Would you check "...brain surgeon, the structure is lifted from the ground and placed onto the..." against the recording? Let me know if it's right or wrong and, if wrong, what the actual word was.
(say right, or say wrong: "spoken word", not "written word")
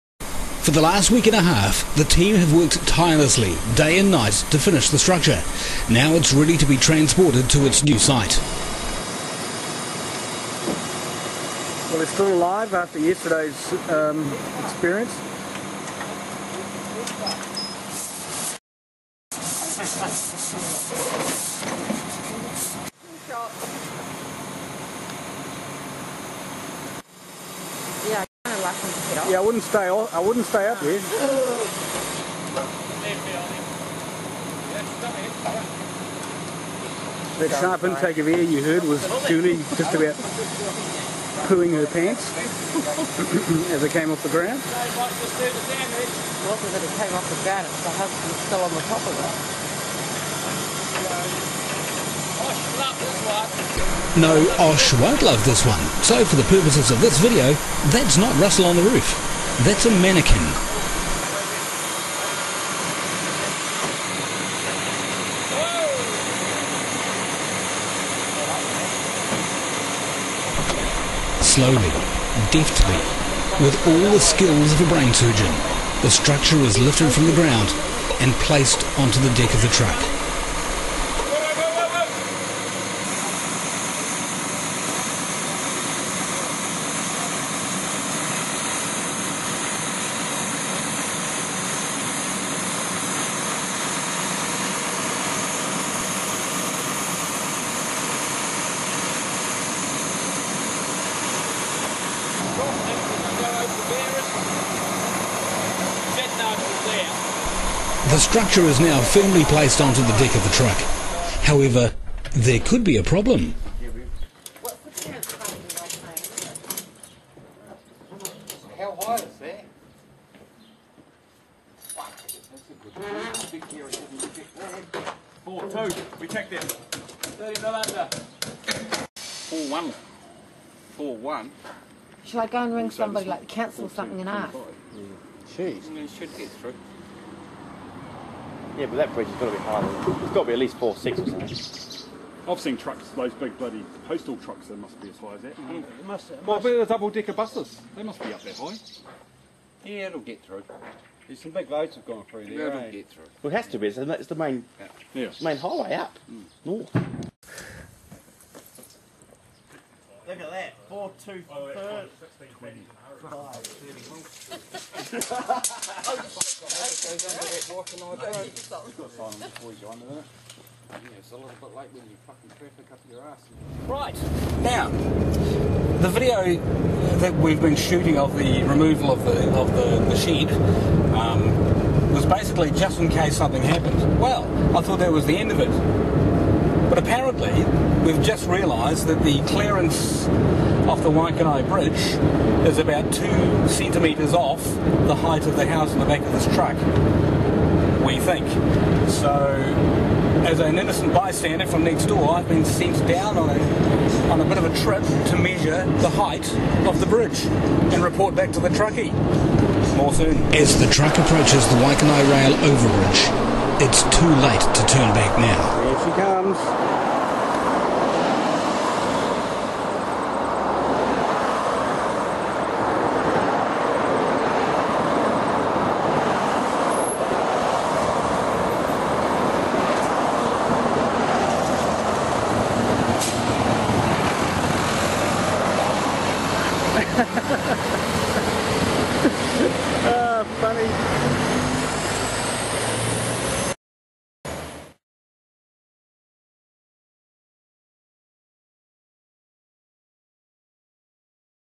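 right.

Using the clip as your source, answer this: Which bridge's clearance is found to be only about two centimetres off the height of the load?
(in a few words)
Waikanae Bridge.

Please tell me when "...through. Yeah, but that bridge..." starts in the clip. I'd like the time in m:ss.
2:16.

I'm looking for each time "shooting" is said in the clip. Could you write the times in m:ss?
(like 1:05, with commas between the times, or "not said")
2:57.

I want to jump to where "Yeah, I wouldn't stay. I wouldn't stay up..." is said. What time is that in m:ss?
0:29.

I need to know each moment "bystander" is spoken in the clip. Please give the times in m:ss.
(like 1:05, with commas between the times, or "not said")
3:21.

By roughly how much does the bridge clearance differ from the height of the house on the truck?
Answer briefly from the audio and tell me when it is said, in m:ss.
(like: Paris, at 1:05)
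2 centimetres, at 3:13.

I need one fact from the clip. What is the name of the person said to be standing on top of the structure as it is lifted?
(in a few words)
Russell.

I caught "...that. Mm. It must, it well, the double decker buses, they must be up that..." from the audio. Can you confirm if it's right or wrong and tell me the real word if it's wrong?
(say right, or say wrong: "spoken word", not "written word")
right.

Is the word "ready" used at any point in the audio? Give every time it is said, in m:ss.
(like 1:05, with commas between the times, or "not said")
0:06.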